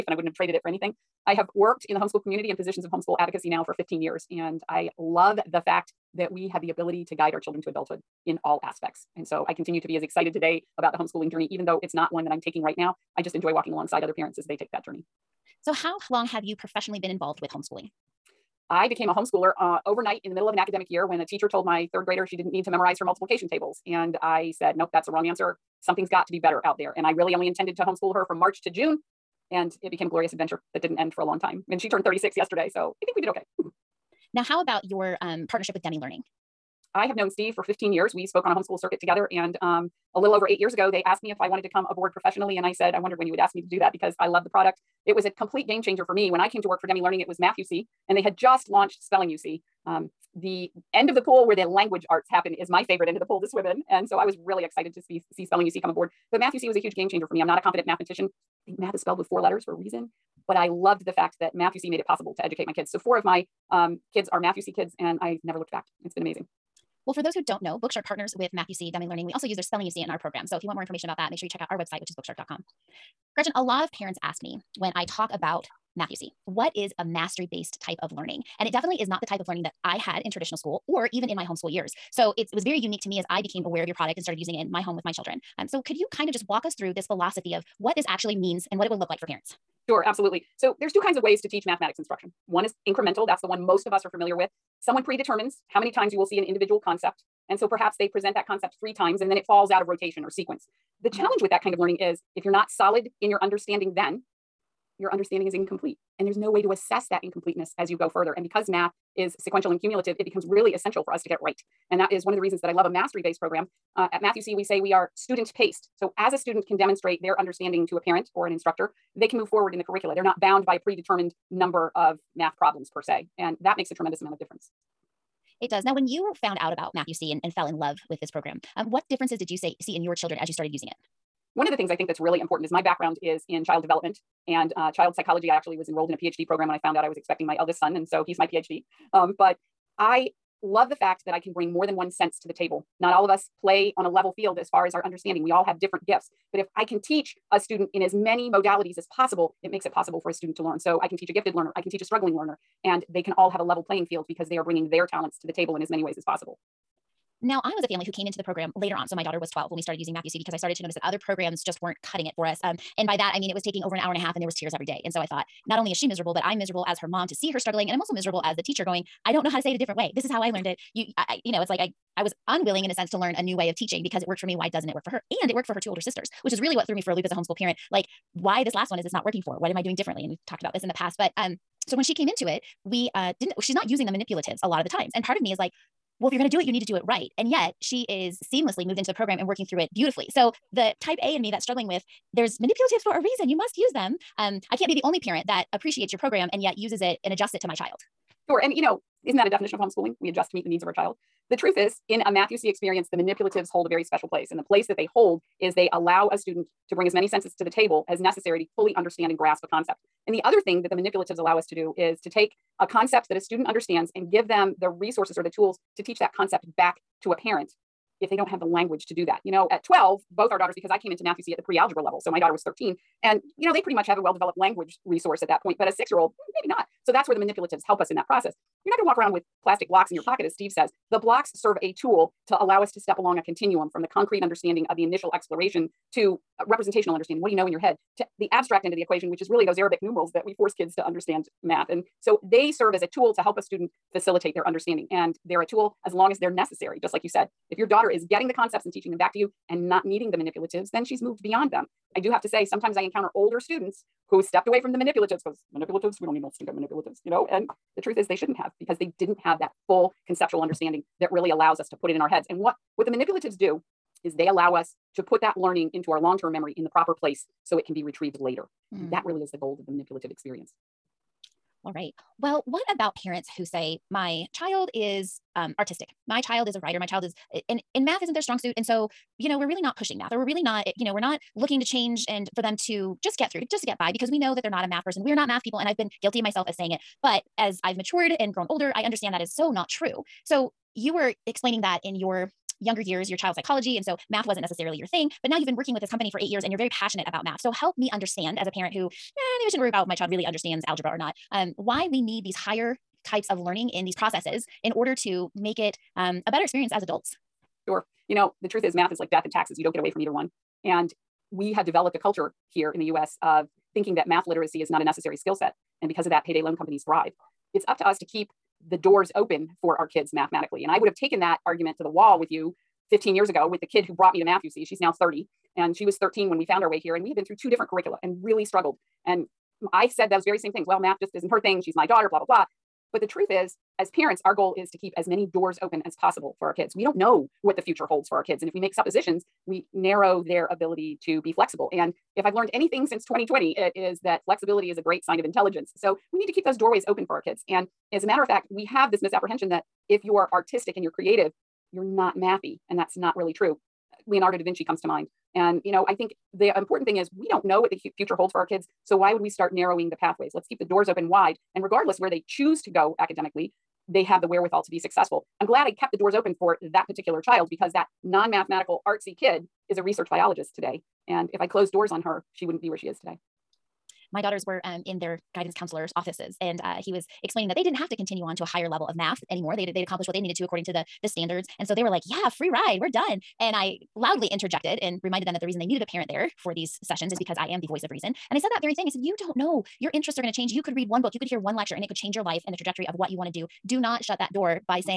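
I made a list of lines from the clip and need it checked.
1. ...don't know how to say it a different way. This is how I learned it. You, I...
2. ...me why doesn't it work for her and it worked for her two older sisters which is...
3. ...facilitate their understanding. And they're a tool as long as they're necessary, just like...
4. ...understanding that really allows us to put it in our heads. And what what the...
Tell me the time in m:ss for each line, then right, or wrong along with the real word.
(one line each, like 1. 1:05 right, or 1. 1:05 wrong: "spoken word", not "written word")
1. 2:49 right
2. 2:54 right
3. 4:04 right
4. 4:20 right.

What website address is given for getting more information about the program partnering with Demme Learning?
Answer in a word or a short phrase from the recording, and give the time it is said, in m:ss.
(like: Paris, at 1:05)
bookshark.com, at 1:12.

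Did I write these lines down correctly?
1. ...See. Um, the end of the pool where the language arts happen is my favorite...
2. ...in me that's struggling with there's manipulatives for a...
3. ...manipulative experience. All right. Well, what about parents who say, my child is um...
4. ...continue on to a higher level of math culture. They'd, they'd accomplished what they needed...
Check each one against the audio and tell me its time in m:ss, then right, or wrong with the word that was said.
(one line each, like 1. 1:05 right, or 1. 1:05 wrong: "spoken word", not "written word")
1. 0:49 right
2. 3:11 right
3. 4:29 right
4. 6:18 wrong: "anymore", not "culture".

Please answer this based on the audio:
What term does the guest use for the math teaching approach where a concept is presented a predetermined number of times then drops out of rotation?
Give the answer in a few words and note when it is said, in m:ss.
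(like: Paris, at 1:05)
incremental, at 1:32.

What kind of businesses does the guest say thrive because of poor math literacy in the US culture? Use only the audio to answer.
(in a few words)
payday loan companies.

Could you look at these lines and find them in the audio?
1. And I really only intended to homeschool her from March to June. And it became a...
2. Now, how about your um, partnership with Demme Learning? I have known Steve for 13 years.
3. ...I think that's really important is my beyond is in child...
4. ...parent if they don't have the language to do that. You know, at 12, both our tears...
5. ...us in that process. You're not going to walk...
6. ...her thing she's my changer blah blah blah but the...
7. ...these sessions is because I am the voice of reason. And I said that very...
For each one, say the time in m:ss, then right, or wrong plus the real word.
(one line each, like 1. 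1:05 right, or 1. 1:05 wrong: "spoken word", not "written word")
1. 0:26 right
2. 0:34 wrong: "15", not "13"
3. 2:11 wrong: "background", not "beyond"
4. 3:37 wrong: "daughters", not "tears"
5. 3:47 right
6. 5:31 wrong: "daughter", not "changer"
7. 6:26 right.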